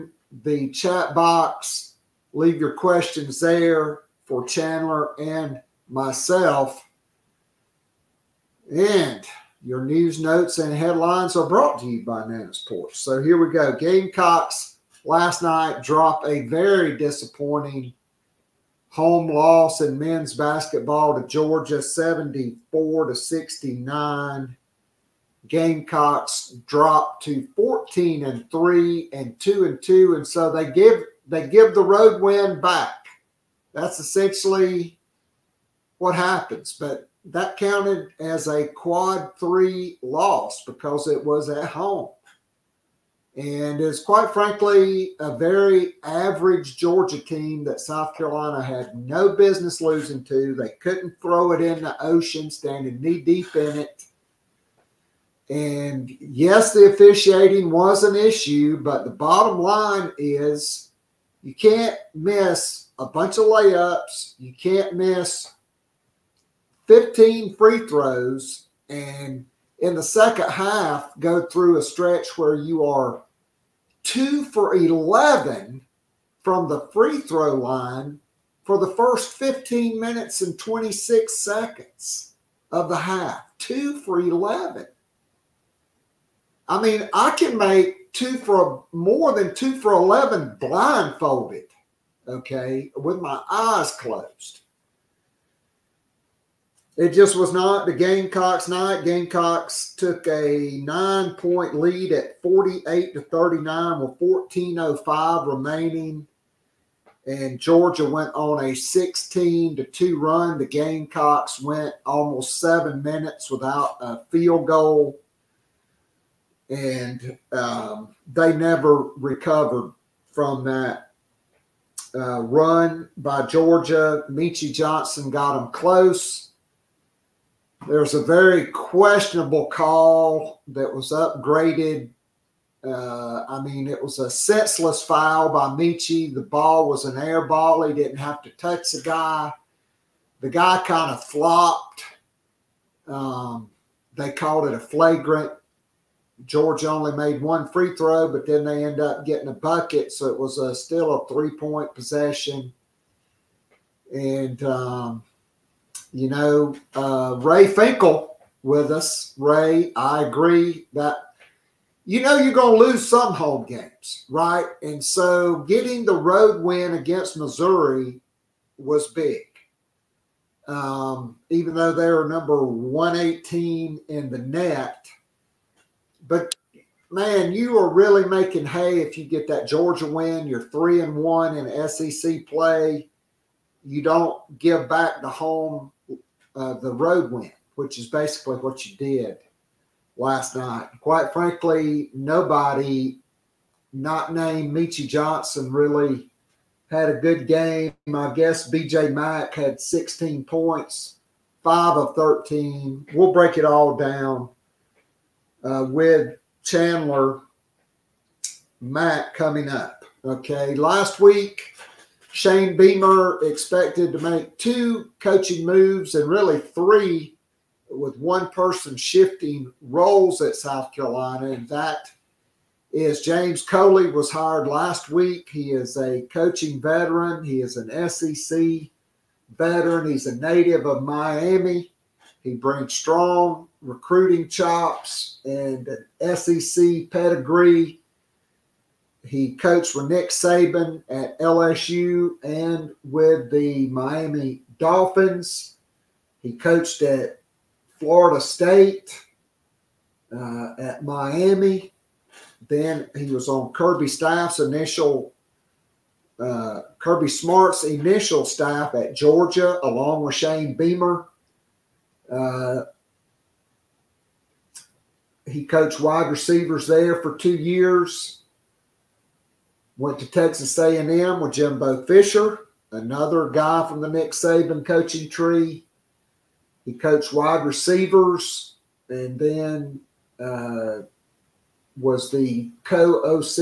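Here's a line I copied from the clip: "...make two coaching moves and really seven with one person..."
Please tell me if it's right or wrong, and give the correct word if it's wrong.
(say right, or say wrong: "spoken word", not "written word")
wrong: "three", not "seven".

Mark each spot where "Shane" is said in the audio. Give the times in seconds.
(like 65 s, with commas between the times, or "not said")
212 s, 260 s.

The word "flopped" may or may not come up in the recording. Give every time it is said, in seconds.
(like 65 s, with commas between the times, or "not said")
141 s.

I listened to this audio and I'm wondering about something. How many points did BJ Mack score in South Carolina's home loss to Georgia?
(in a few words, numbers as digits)
16.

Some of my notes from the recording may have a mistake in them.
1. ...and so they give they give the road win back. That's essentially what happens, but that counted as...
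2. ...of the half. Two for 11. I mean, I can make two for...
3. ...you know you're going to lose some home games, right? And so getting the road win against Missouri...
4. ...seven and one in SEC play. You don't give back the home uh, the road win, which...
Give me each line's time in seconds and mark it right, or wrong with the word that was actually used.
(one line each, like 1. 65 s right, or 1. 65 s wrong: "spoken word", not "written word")
1. 30 s right
2. 82 s right
3. 162 s right
4. 180 s wrong: "three", not "seven".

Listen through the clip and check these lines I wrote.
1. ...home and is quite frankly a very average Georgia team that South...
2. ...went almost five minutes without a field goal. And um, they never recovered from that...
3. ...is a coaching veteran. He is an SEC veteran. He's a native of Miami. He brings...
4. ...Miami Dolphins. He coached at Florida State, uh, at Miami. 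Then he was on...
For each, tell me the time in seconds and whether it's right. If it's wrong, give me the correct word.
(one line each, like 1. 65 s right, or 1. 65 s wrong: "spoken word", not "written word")
1. 41 s right
2. 111 s wrong: "seven", not "five"
3. 225 s right
4. 243 s right.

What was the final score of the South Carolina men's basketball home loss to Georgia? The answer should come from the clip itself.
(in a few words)
74 to 69.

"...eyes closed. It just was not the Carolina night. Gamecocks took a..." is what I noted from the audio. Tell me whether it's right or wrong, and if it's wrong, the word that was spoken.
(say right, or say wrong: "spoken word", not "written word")
wrong: "Gamecocks", not "Carolina".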